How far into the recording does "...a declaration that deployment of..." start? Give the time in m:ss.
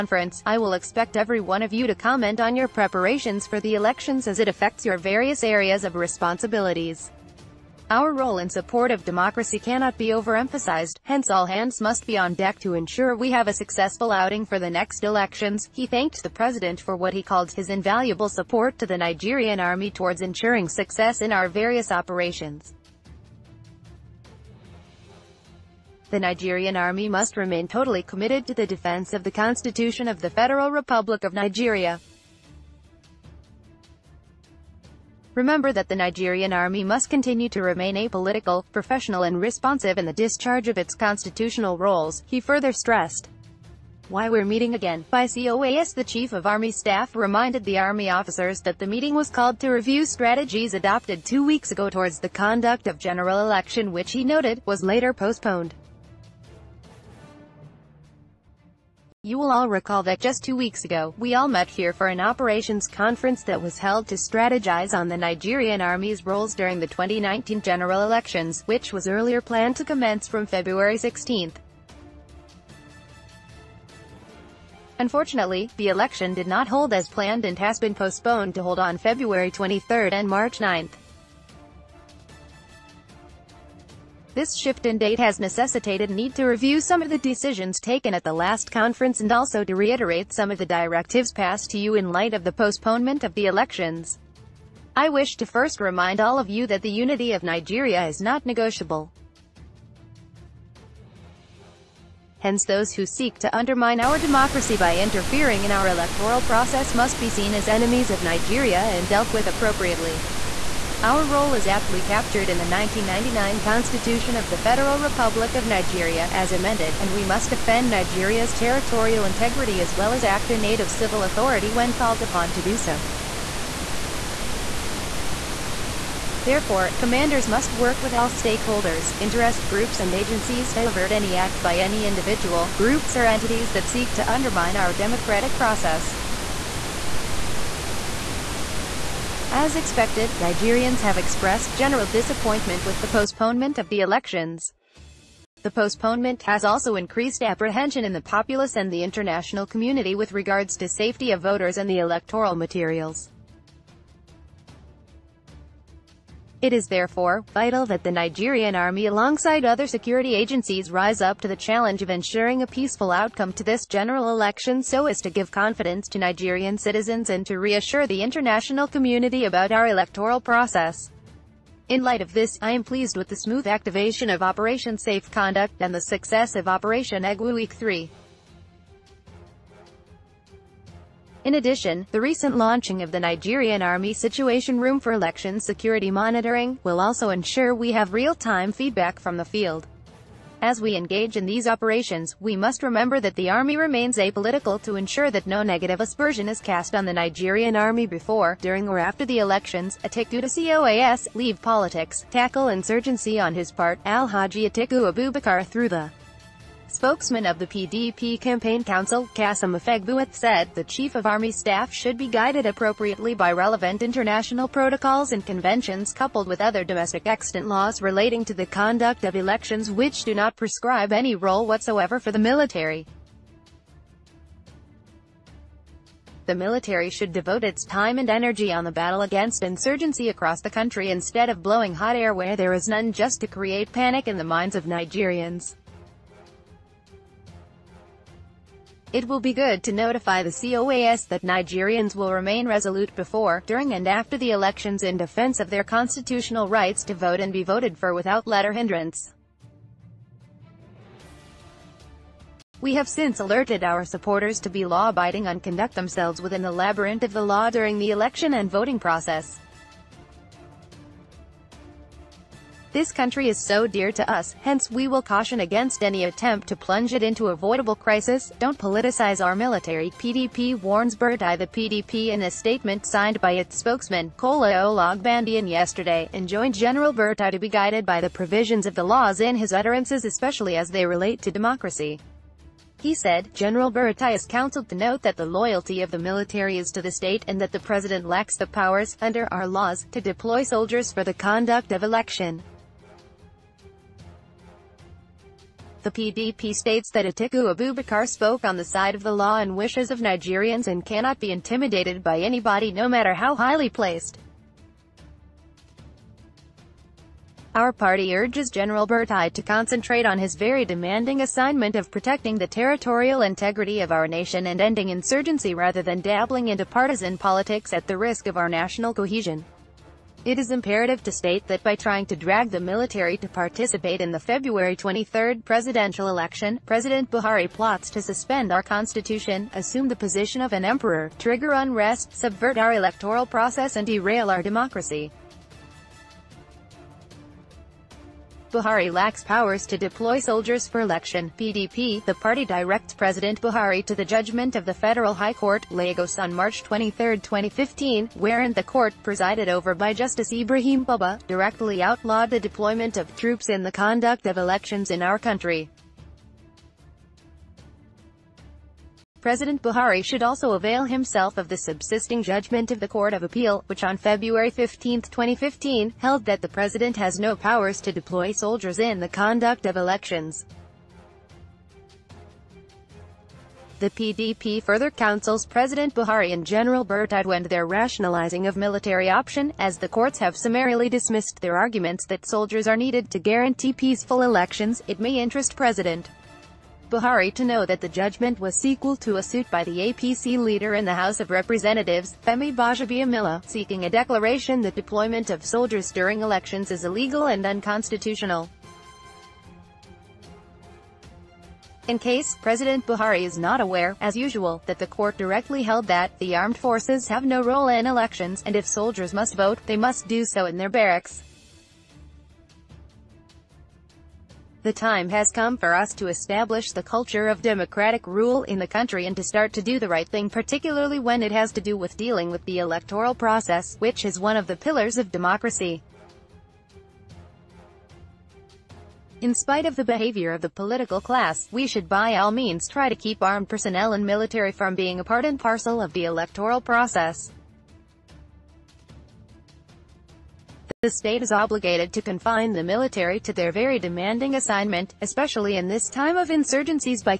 6:34.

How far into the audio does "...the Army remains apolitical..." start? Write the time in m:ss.
3:13.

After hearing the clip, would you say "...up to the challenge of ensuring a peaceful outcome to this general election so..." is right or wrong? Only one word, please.
right.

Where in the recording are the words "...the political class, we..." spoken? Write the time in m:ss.
7:10.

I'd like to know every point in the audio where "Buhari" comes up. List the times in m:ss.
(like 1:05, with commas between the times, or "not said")
5:27, 5:38, 5:43, 5:59, 6:16, 6:27, 6:43.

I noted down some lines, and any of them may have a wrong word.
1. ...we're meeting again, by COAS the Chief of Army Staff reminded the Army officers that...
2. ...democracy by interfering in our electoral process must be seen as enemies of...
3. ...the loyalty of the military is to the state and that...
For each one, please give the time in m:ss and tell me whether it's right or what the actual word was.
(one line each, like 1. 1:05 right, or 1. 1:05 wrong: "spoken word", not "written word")
1. 0:44 right
2. 1:44 right
3. 4:45 right.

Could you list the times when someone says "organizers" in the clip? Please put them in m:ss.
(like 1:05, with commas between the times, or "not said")
not said.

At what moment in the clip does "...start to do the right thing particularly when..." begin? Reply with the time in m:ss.
6:59.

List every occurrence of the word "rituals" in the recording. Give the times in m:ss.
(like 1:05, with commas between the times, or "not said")
not said.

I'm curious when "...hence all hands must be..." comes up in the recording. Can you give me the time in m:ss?
0:11.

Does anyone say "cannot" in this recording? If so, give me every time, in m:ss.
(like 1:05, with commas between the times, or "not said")
0:09, 5:01.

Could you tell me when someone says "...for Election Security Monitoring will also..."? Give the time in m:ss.
3:04.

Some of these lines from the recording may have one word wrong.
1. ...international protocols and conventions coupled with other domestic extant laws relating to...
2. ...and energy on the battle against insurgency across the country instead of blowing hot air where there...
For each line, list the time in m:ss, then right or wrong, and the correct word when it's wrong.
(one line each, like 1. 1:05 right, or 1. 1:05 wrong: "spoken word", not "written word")
1. 3:34 right
2. 3:48 right.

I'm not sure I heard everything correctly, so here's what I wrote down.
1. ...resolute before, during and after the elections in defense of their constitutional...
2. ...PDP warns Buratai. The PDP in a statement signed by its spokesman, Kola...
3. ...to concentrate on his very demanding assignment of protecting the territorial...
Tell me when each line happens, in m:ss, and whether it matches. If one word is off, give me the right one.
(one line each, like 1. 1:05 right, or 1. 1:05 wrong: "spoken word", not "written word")
1. 4:02 right
2. 4:30 right
3. 5:09 right.